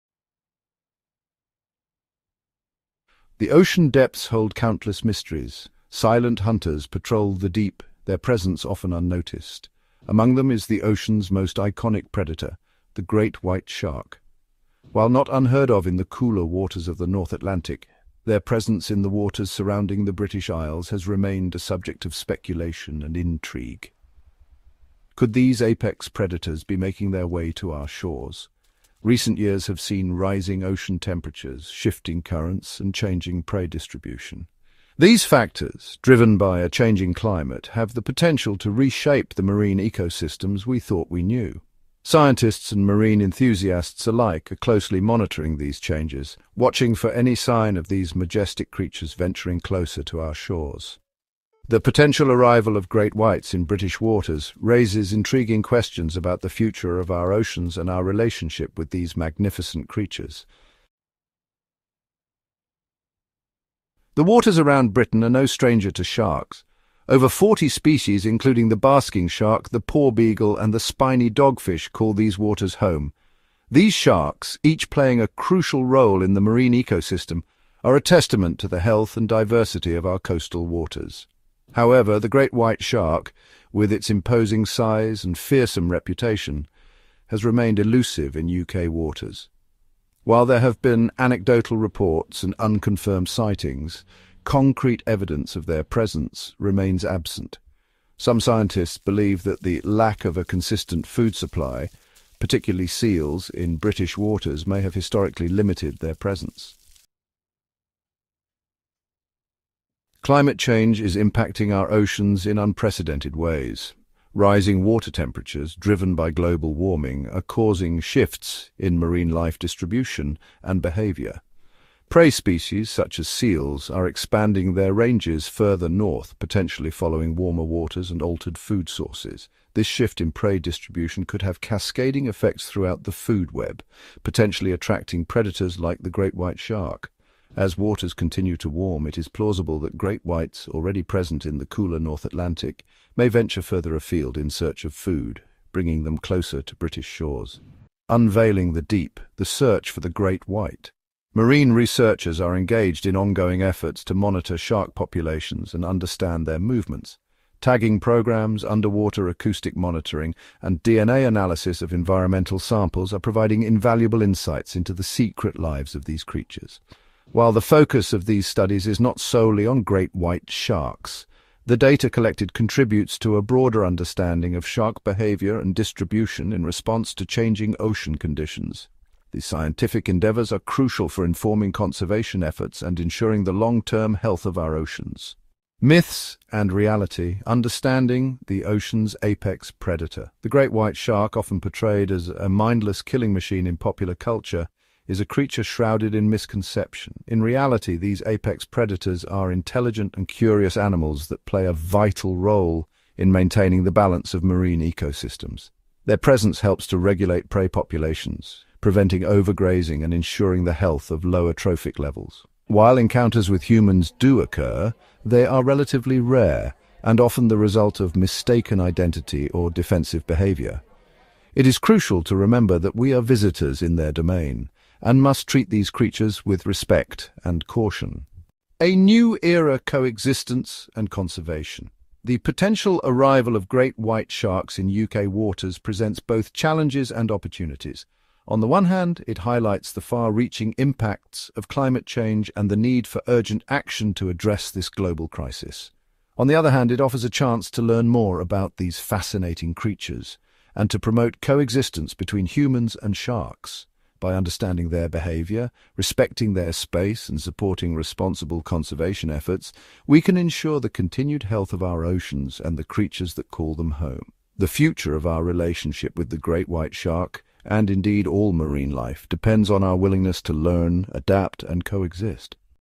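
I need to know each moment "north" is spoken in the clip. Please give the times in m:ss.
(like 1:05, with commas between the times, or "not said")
0:17, 2:05, 2:21.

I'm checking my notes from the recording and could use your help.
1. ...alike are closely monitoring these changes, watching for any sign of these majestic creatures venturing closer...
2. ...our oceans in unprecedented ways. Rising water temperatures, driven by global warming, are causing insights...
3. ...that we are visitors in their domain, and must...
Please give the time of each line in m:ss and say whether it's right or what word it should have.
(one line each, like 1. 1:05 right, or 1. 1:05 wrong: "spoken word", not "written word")
1. 0:44 right
2. 1:51 wrong: "shifts", not "insights"
3. 3:42 right.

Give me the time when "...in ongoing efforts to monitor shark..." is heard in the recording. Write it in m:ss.
2:33.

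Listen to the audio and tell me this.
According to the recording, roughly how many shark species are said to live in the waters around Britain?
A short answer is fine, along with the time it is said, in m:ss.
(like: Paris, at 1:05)
Over 40, at 1:07.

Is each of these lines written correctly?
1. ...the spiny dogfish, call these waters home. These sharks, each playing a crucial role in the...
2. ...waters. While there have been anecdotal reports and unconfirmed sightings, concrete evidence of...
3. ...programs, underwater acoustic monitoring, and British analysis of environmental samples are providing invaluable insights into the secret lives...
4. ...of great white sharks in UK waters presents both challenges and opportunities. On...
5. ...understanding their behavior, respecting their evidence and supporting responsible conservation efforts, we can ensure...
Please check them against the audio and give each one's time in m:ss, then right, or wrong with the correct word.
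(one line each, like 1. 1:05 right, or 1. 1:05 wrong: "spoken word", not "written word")
1. 1:10 right
2. 1:28 right
3. 2:37 wrong: "DNA", not "British"
4. 3:53 right
5. 4:14 wrong: "space", not "evidence".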